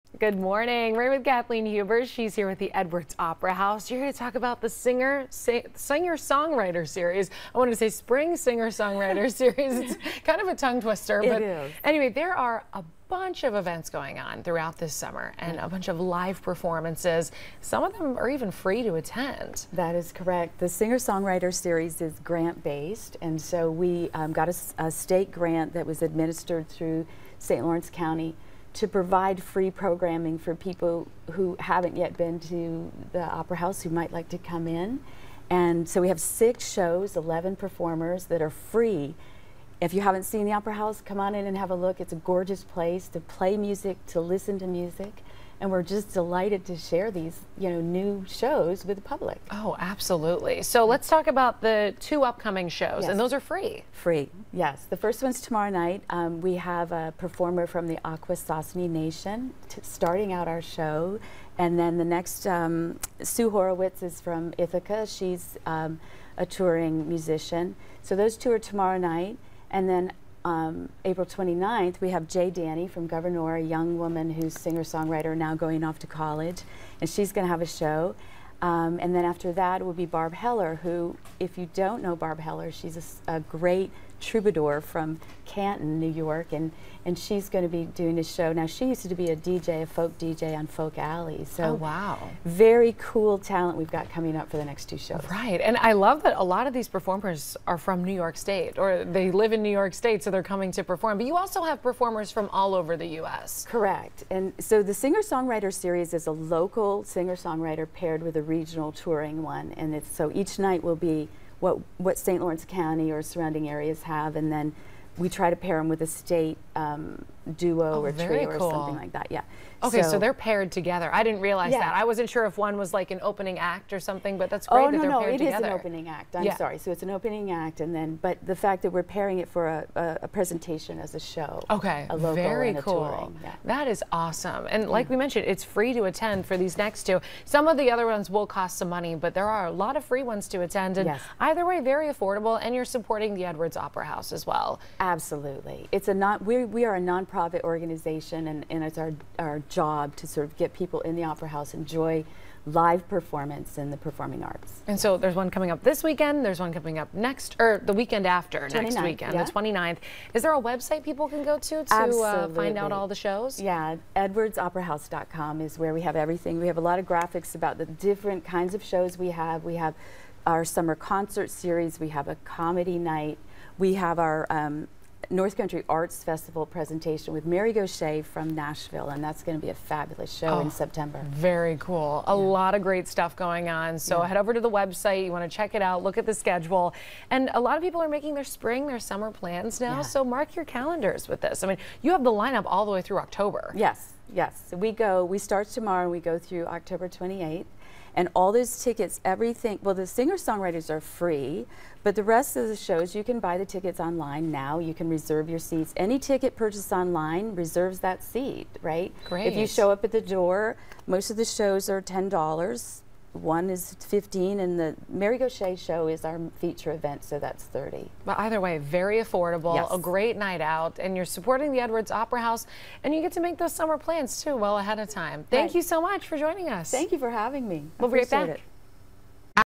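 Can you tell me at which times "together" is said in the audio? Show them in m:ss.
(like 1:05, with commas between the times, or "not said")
2:00, 2:05.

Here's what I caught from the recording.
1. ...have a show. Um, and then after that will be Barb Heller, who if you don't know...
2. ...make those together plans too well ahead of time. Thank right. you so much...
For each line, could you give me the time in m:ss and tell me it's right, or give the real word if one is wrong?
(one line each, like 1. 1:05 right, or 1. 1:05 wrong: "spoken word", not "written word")
1. 1:17 right
2. 3:43 wrong: "summer", not "together".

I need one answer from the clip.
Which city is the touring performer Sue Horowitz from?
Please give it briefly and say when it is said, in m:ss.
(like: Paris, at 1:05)
Ithaca, at 1:04.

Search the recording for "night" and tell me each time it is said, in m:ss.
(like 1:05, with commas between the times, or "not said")
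0:55, 1:08, 1:50, 2:52, 3:40.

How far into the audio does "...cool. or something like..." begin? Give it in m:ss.
1:58.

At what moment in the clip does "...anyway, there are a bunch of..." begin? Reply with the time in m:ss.
0:11.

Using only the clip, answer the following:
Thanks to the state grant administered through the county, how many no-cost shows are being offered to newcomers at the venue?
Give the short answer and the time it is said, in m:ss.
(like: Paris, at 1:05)
6, at 0:36.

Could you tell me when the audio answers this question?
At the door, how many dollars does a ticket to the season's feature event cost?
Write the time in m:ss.
3:37.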